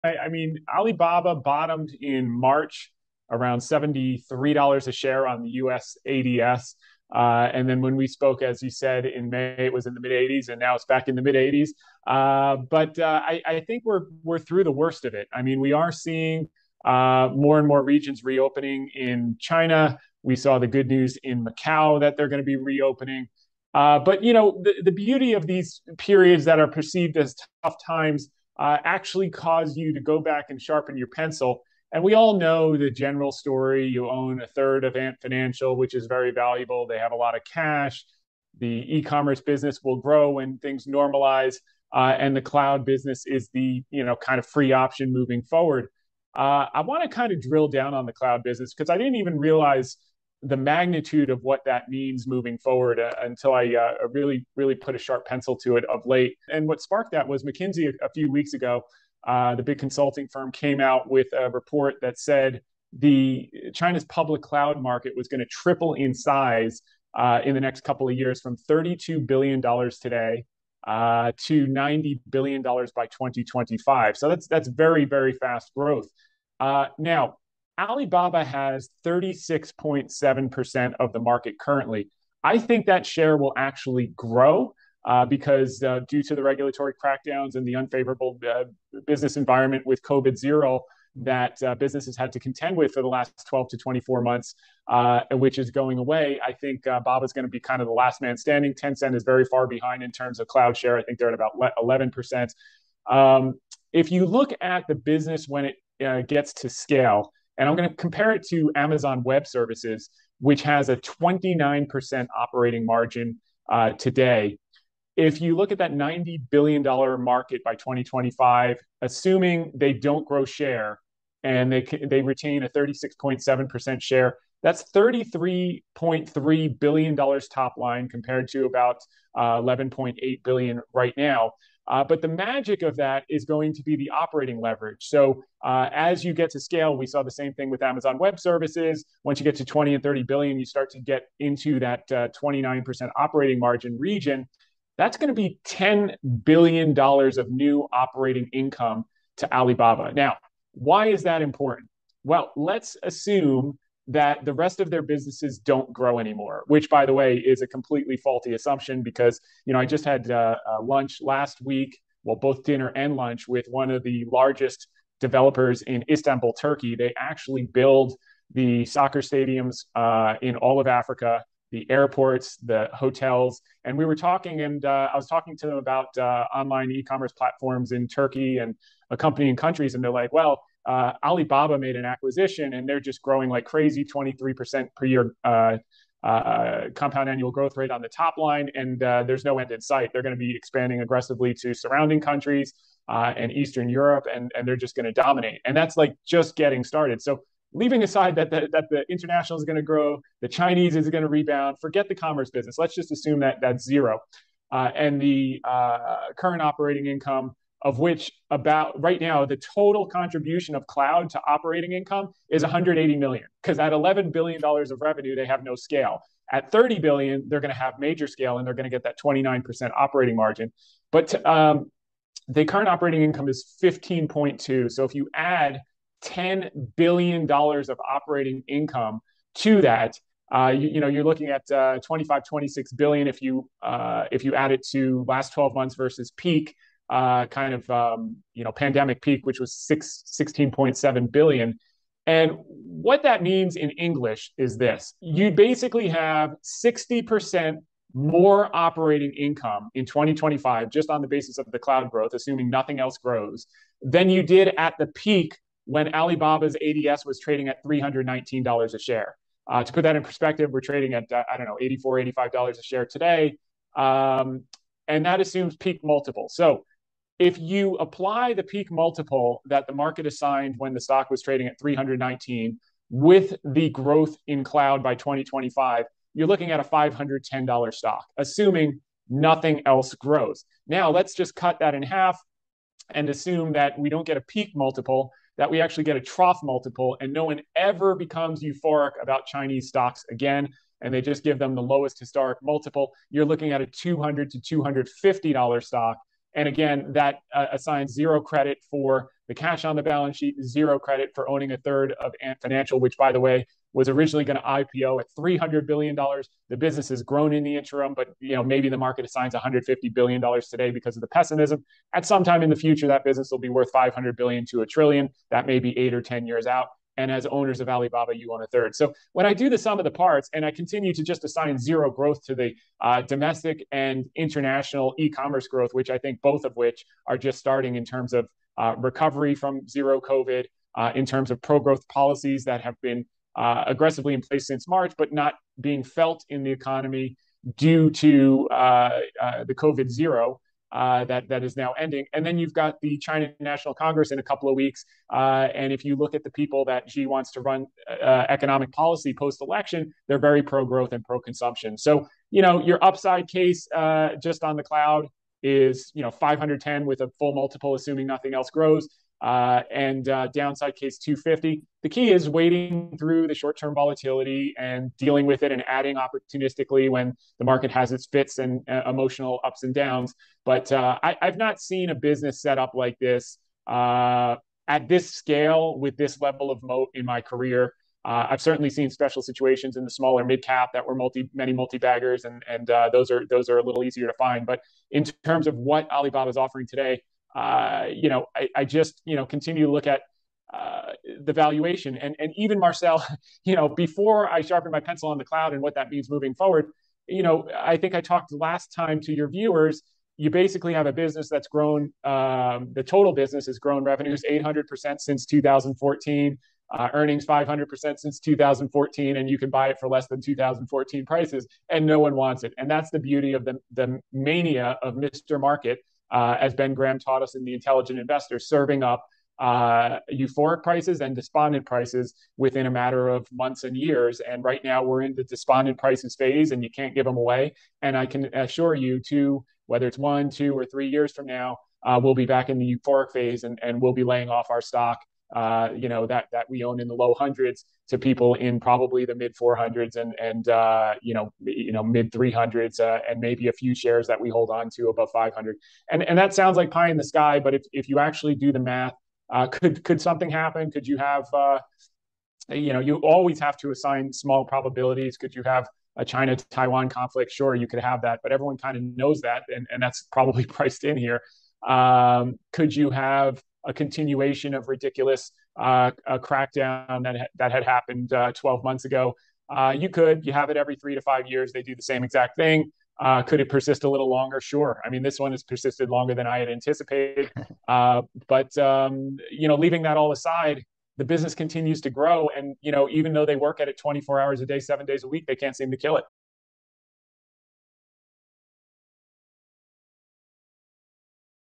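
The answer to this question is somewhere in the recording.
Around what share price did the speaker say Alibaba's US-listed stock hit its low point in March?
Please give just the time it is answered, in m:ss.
0:03.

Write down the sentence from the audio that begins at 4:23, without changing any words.
Um, and that assumes peak multiple.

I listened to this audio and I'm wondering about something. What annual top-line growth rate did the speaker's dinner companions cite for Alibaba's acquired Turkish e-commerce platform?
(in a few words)
23%.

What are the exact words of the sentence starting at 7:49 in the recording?
Uh, you could, you have it every three to five years.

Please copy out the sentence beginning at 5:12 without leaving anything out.
At some time in the future, that business will be worth 500 billion to a trillion.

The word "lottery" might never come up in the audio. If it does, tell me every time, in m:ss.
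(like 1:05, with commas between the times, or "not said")
not said.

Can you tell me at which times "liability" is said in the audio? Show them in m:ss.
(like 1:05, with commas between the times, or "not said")
not said.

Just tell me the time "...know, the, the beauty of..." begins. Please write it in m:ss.
0:24.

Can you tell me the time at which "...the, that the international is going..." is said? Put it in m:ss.
3:18.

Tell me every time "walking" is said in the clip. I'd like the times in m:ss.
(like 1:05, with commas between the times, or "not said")
not said.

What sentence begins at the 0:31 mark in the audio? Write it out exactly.
And we all know the general story.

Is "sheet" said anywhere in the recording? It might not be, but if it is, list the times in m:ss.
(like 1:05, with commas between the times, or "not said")
5:00.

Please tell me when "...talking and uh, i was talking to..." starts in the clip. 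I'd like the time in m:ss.
2:54.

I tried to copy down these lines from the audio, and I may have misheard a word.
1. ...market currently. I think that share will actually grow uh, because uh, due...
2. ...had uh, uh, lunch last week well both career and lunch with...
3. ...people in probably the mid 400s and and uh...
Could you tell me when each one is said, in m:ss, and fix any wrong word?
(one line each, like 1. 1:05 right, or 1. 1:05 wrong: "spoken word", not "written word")
1. 1:21 right
2. 2:40 wrong: "dinner", not "career"
3. 7:18 right.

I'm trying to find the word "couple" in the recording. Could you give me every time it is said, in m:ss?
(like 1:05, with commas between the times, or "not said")
1:07, 5:44.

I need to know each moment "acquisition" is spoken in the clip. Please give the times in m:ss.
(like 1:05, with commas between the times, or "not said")
3:02.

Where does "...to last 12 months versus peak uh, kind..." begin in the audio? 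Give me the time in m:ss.
3:54.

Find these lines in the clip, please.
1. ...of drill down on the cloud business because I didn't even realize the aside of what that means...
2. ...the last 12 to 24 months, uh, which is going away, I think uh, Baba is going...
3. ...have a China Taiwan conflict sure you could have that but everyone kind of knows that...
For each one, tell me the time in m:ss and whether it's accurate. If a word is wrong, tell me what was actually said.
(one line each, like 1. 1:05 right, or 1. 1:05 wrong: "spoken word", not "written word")
1. 0:47 wrong: "magnitude", not "aside"
2. 1:33 right
3. 7:35 right.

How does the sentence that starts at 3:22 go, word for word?
Let's just assume that that's zero.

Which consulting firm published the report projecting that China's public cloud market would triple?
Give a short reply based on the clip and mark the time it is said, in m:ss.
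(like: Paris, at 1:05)
McKinsey, at 0:57.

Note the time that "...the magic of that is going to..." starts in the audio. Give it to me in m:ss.
2:12.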